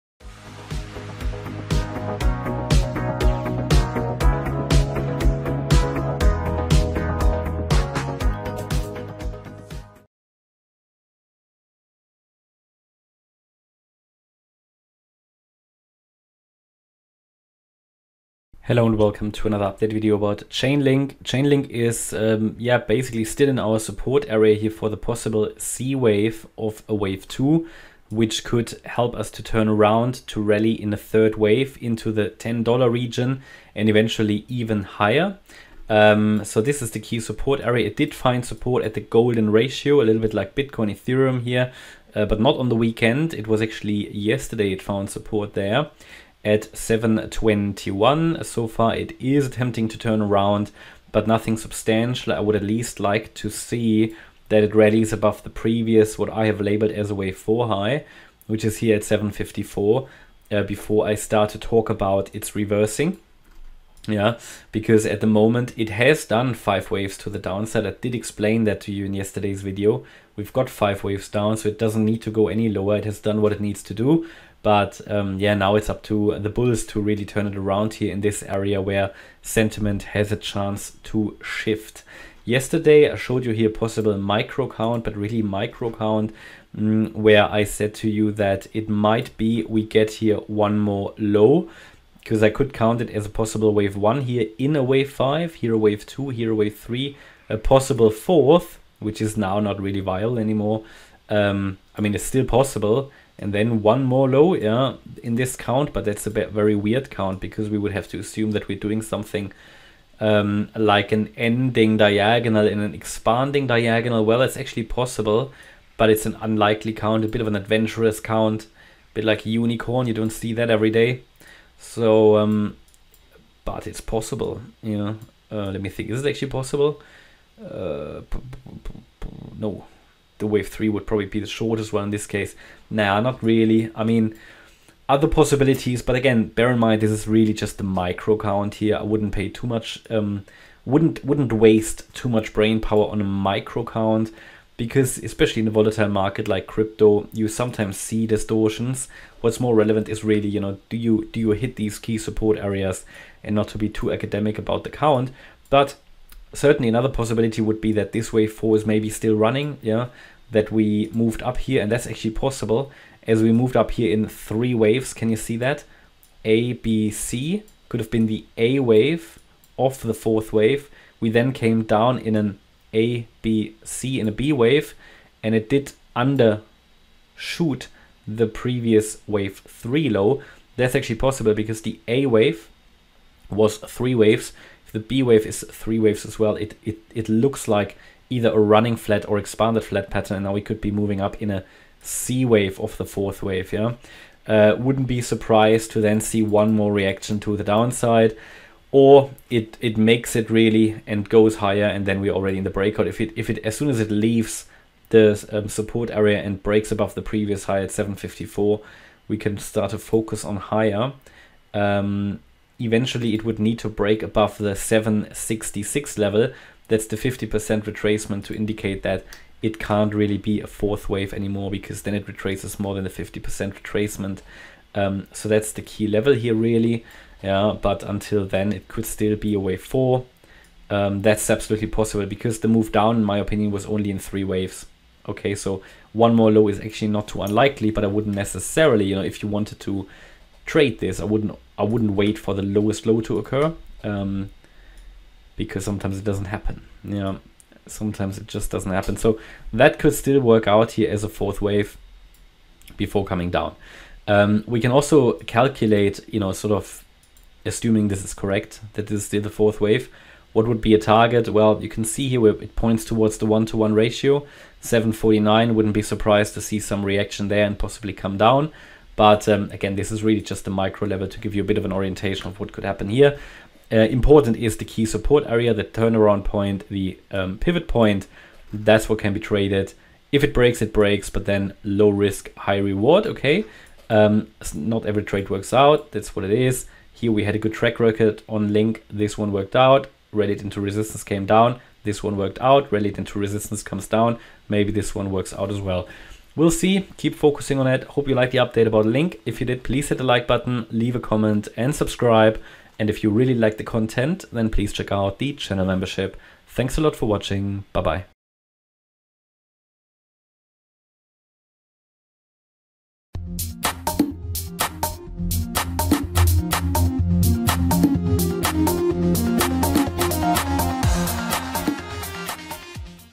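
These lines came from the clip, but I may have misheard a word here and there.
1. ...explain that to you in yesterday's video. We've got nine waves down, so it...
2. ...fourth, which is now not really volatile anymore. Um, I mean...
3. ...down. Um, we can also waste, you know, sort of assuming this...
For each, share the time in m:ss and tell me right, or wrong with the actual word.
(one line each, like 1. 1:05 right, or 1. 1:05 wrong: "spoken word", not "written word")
1. 1:08 wrong: "five", not "nine"
2. 1:38 wrong: "viable", not "volatile"
3. 4:13 wrong: "calculate", not "waste".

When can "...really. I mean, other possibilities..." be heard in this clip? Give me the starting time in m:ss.
2:13.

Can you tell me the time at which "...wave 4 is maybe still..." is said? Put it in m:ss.
2:38.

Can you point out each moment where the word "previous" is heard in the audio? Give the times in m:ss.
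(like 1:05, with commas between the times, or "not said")
0:55, 2:58, 3:27.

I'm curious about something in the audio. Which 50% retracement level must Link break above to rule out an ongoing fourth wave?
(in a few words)
766.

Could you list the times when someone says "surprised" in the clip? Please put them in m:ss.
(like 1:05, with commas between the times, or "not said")
3:15, 4:26.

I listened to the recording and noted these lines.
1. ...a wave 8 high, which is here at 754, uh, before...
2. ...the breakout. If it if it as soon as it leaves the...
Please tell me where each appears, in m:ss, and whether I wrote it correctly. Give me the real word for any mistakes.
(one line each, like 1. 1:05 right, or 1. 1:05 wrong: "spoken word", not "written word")
1. 0:57 wrong: "4", not "8"
2. 3:22 right.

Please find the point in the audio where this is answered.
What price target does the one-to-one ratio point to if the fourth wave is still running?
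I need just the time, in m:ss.
4:24.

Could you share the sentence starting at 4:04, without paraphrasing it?
Um, because sometimes it doesn't happen.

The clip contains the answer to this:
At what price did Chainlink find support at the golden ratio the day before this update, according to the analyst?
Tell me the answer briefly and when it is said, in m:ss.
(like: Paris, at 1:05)
721, at 0:46.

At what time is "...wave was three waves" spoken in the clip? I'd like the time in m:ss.
3:02.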